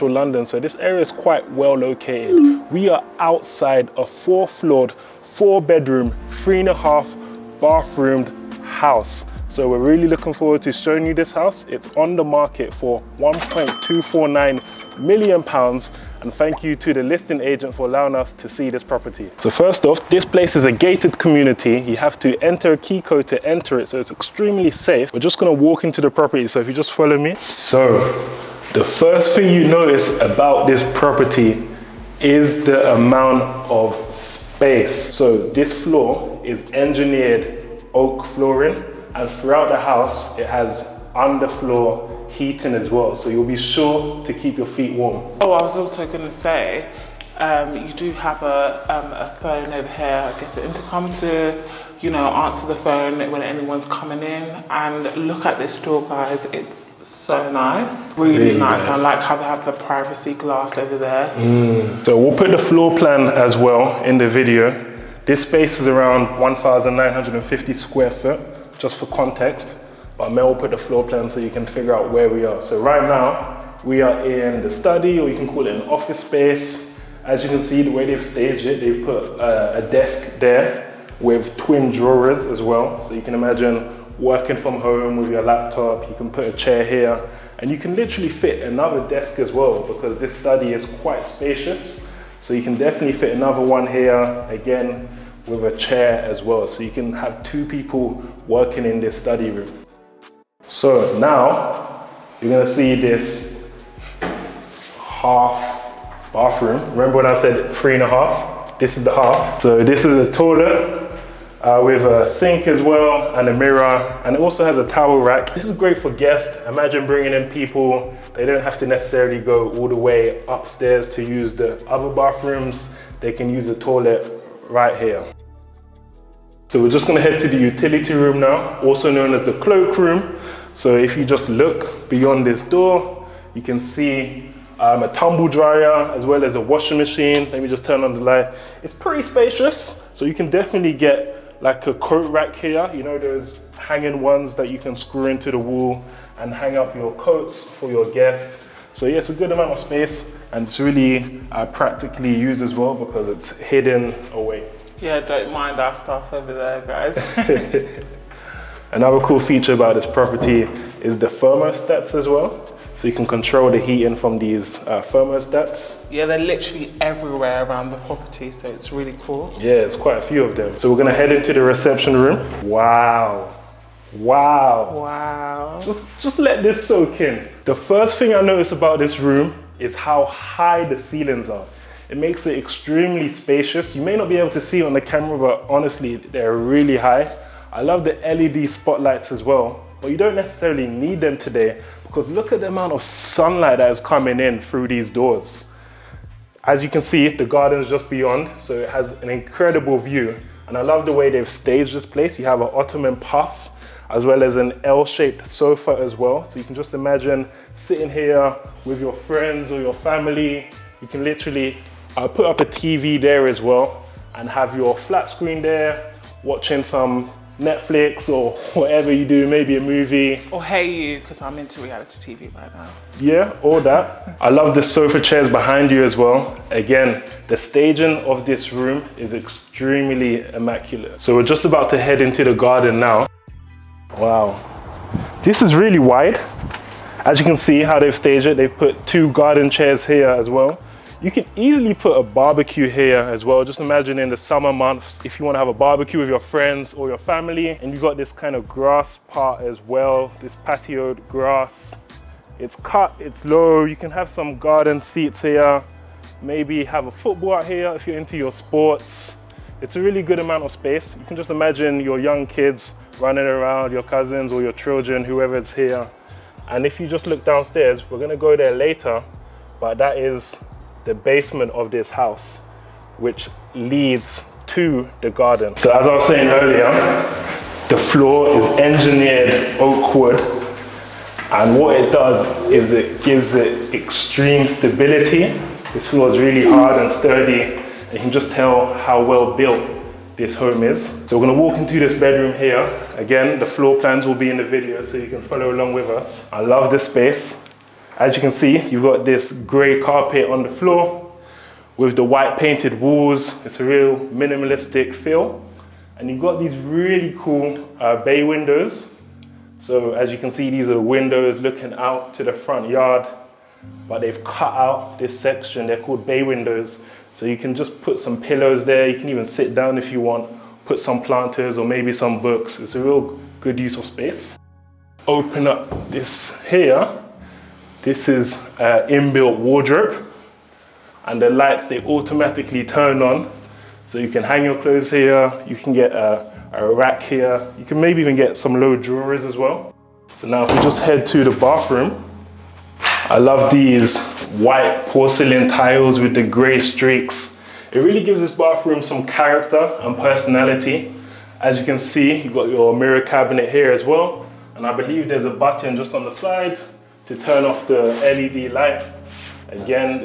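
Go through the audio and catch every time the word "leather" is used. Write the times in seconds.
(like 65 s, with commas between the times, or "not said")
not said.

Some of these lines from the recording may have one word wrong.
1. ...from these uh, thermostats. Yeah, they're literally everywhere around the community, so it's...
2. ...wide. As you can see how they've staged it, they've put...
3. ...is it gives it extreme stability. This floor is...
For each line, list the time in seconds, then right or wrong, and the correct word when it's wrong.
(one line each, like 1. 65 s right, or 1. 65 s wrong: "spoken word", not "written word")
1. 164 s wrong: "property", not "community"
2. 235 s right
3. 282 s right.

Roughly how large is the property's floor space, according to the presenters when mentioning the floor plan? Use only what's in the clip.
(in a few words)
1,950 square feet.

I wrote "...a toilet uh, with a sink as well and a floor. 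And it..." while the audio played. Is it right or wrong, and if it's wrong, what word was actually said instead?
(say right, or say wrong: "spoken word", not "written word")
wrong: "mirror", not "floor".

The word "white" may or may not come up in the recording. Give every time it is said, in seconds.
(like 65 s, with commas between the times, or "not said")
302 s, 344 s.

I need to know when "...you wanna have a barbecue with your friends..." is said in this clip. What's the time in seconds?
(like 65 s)
245 s.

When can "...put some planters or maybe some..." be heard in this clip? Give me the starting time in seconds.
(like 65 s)
320 s.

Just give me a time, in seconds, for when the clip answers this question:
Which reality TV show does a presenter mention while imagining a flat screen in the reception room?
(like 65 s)
220 s.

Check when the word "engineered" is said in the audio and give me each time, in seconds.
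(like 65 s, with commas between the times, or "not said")
36 s, 278 s.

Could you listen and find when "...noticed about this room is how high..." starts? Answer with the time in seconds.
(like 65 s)
178 s.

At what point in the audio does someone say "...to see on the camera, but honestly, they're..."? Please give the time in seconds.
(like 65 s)
184 s.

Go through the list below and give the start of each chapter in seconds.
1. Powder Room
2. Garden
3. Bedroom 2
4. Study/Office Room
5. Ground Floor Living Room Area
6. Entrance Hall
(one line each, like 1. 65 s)
1. 104 s
2. 230 s
3. 293 s
4. 65 s
5. 170 s
6. 27 s.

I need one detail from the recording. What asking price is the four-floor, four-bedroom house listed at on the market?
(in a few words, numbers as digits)
£1.249 million.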